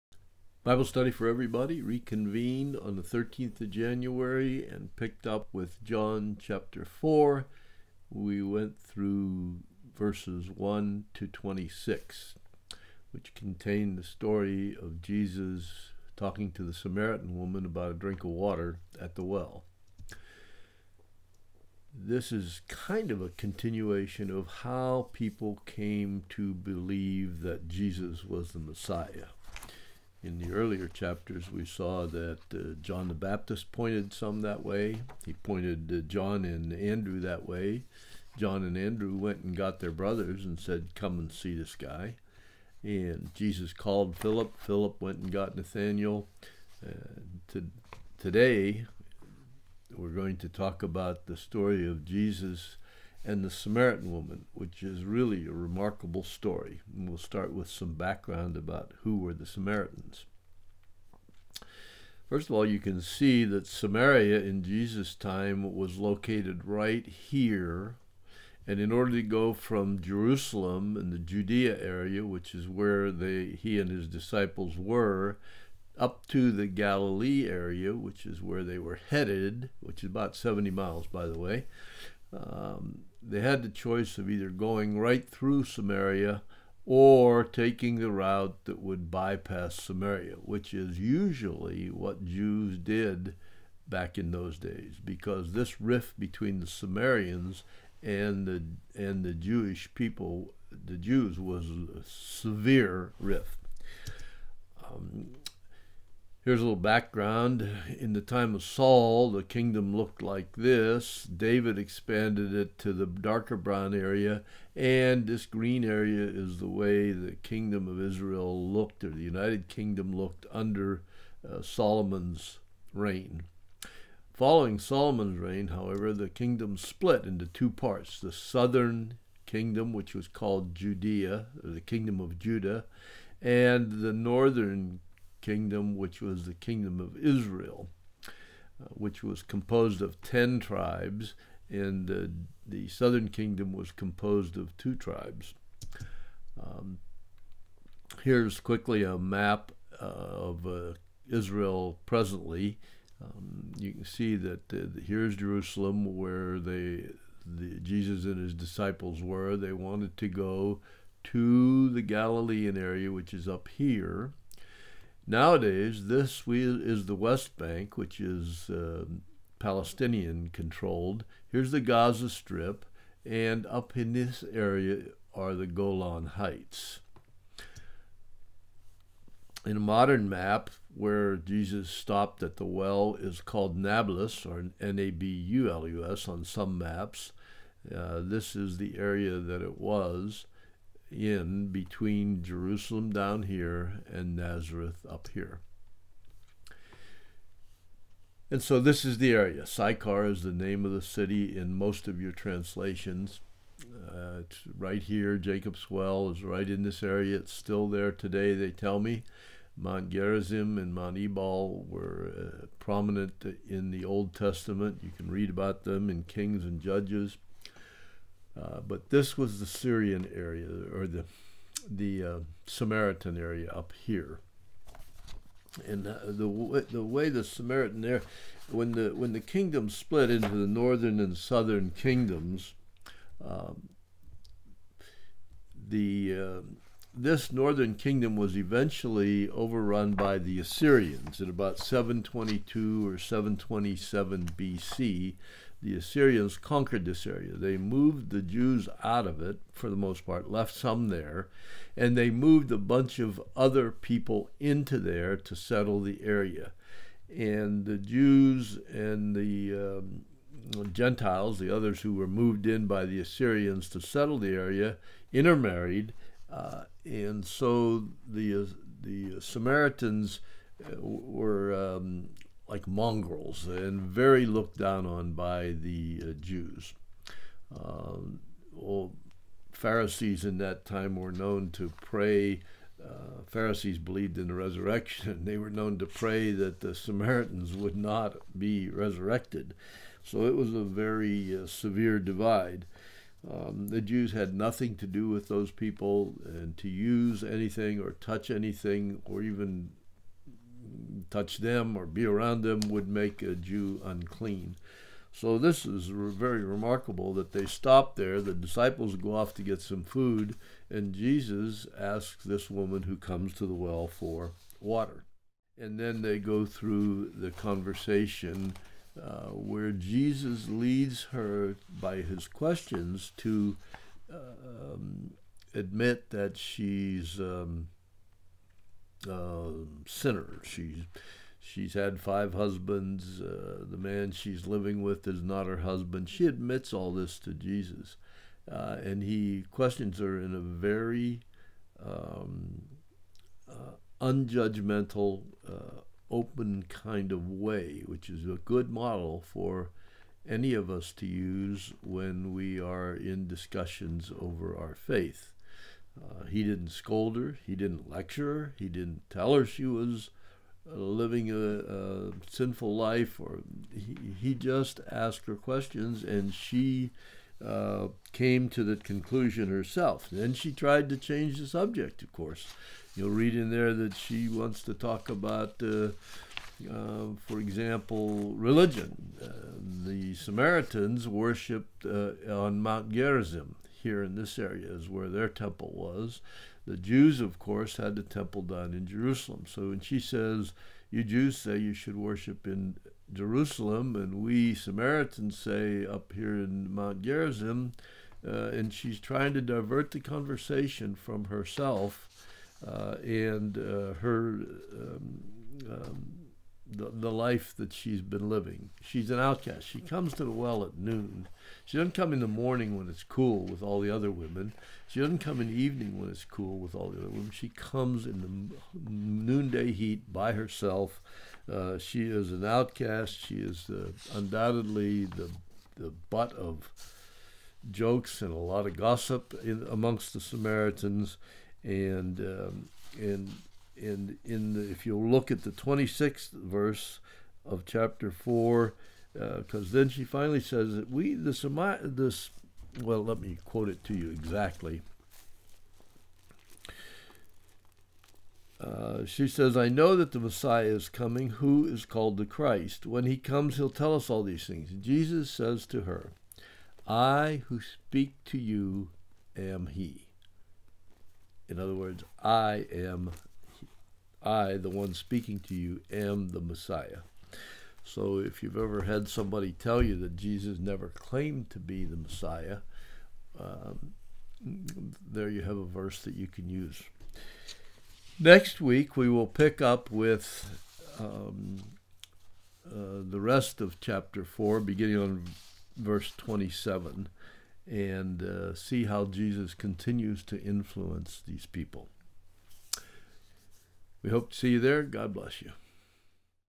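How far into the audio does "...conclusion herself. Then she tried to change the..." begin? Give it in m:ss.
6:08.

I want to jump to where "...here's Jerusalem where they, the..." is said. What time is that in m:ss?
2:35.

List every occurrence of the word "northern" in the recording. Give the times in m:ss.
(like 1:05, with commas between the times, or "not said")
2:14, 3:50, 3:57.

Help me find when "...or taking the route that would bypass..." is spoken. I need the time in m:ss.
1:26.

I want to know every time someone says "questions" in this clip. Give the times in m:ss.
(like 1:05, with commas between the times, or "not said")
5:22, 5:39, 6:05.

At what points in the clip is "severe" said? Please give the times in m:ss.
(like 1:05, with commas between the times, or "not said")
1:42, 4:51.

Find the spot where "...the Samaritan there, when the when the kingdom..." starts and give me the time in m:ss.
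3:47.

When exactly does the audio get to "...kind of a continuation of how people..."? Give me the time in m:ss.
0:22.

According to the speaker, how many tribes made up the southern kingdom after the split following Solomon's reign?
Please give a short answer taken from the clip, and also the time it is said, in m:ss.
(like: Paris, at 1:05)
2, at 2:24.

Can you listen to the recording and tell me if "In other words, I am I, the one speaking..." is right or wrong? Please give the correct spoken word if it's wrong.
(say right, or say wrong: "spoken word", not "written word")
right.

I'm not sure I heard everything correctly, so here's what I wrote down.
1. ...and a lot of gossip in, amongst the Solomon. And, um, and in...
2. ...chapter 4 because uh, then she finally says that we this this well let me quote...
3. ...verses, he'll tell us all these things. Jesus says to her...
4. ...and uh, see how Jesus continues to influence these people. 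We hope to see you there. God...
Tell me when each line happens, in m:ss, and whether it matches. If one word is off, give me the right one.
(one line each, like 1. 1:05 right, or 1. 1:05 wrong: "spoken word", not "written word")
1. 7:08 wrong: "Samaritans", not "Solomon"
2. 7:17 right
3. 7:33 wrong: "comes", not "verses"
4. 8:07 right.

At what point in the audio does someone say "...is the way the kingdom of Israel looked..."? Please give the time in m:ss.
1:56.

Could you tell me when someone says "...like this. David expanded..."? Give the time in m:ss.
1:50.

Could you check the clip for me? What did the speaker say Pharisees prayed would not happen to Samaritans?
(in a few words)
be resurrected.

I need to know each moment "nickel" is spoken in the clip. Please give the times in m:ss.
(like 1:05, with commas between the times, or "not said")
not said.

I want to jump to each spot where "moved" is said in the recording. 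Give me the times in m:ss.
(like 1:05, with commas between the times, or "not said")
4:07, 4:12, 4:22.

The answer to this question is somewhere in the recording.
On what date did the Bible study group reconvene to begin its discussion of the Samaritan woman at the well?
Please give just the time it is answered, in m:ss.
0:03.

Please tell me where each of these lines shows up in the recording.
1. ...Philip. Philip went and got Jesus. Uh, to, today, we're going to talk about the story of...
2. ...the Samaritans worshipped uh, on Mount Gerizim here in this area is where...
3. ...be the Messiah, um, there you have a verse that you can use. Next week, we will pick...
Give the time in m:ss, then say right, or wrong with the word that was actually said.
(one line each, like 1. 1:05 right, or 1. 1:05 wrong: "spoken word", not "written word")
1. 0:44 wrong: "Nathaniel", not "Jesus"
2. 6:20 right
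3. 7:51 right.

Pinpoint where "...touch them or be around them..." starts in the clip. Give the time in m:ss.
5:01.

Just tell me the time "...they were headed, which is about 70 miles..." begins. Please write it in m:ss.
1:18.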